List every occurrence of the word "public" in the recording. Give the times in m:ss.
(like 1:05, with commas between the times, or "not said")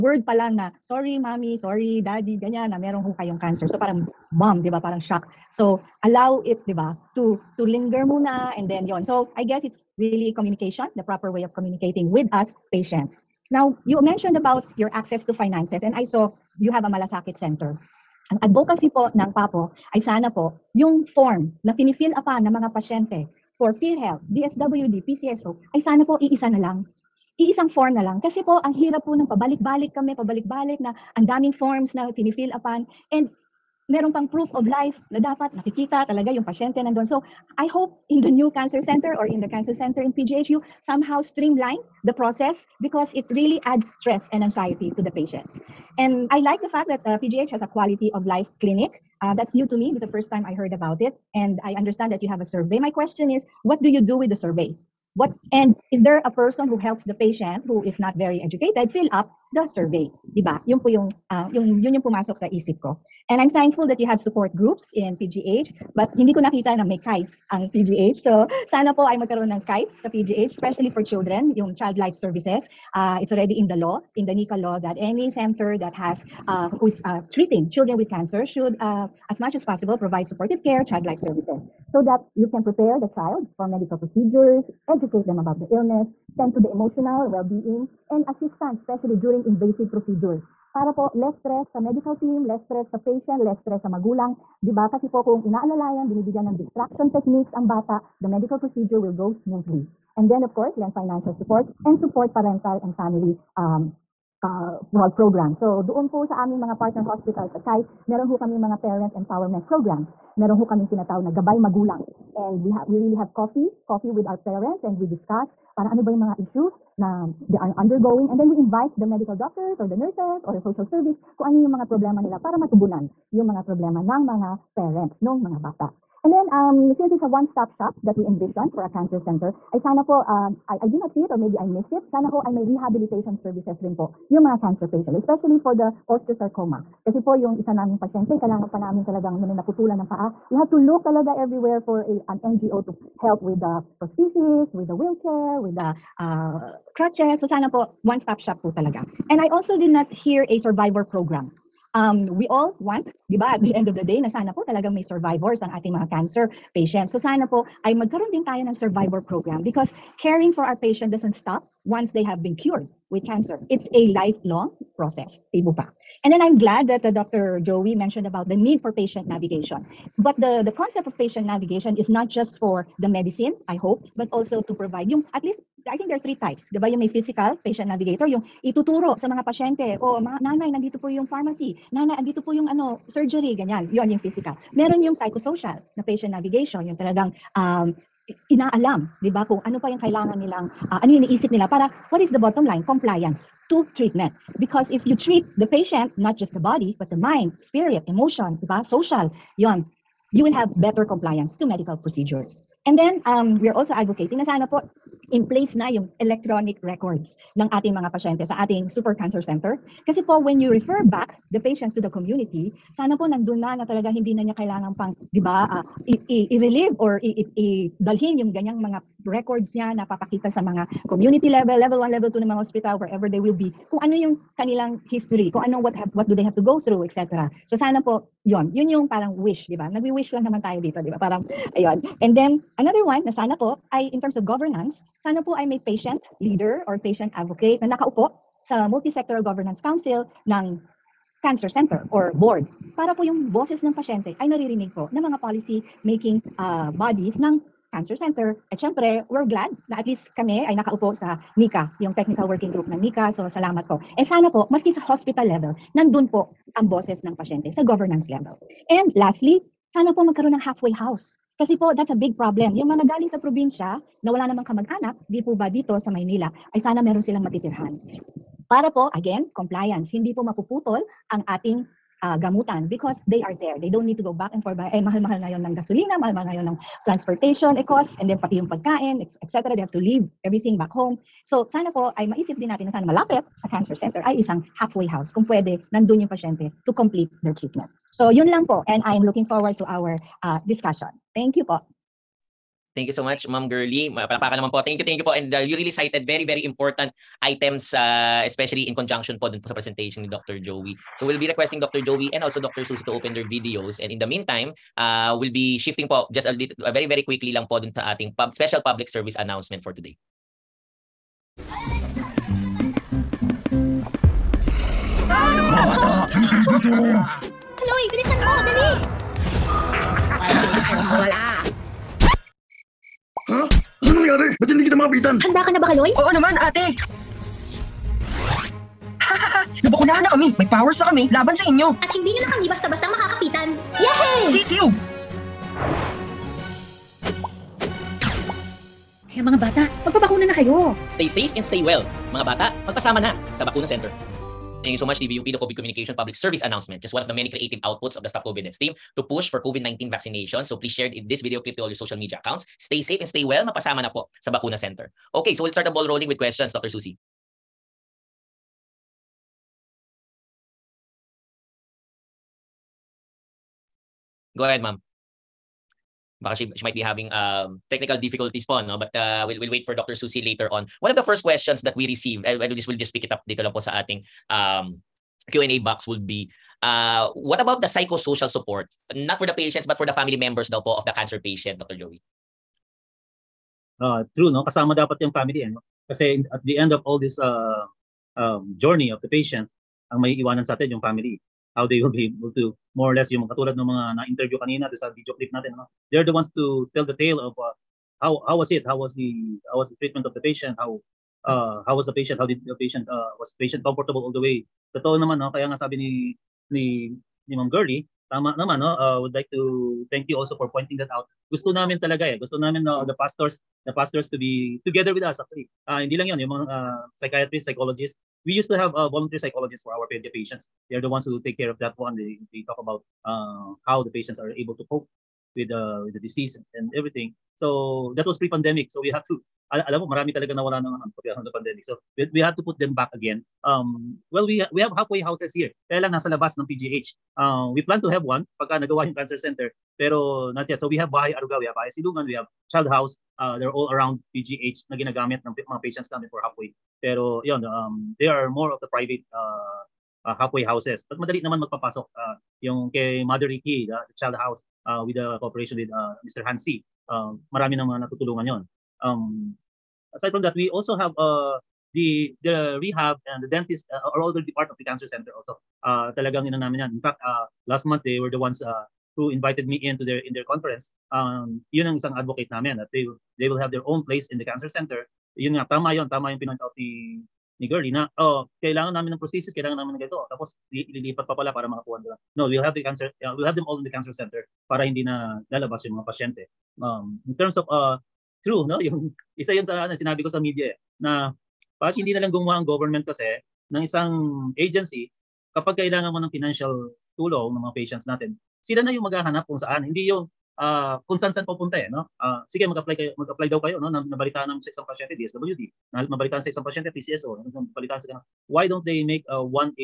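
5:08, 5:46.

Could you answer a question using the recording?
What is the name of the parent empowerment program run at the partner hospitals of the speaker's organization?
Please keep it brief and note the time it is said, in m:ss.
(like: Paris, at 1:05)
Gabay Magulang, at 1:51.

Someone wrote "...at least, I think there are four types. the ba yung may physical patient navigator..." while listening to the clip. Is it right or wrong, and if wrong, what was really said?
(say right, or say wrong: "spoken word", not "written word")
wrong: "three", not "four".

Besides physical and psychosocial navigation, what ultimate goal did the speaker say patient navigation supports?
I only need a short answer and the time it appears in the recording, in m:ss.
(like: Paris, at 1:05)
compliance to treatment, at 3:12.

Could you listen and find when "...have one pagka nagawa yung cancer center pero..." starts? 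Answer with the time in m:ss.
7:18.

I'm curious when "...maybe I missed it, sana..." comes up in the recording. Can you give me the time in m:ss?
2:11.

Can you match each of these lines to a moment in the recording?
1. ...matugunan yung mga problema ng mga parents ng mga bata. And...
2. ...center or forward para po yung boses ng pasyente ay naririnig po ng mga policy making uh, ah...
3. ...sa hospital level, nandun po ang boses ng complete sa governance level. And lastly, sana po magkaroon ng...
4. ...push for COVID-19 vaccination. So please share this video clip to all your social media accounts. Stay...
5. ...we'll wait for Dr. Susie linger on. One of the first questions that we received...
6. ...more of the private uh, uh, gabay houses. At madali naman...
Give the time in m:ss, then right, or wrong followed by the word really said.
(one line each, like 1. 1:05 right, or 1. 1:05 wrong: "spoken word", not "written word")
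1. 2:02 right
2. 4:01 wrong: "board", not "forward"
3. 4:14 wrong: "pasyente", not "complete"
4. 5:49 right
5. 6:09 wrong: "later", not "linger"
6. 7:28 wrong: "halfway", not "gabay".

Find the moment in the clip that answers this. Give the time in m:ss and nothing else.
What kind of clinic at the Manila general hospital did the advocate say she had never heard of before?
0:47.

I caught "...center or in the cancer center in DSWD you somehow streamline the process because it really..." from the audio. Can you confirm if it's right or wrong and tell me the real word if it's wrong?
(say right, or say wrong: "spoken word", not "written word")
wrong: "PGH", not "DSWD".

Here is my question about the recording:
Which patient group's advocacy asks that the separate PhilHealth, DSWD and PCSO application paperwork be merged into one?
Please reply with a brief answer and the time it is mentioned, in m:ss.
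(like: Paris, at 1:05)
PAPO, at 0:19.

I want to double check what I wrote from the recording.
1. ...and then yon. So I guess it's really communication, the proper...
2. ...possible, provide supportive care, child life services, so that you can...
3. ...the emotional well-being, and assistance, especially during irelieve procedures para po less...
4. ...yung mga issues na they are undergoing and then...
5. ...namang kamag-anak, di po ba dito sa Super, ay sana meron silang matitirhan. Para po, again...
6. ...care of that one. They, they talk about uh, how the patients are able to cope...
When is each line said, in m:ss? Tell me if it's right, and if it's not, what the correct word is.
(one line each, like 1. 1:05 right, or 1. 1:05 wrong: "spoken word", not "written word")
1. 0:08 right
2. 1:19 right
3. 1:26 wrong: "invasive", not "irelieve"
4. 1:56 right
5. 4:24 wrong: "Maynila", not "Super"
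6. 7:01 right.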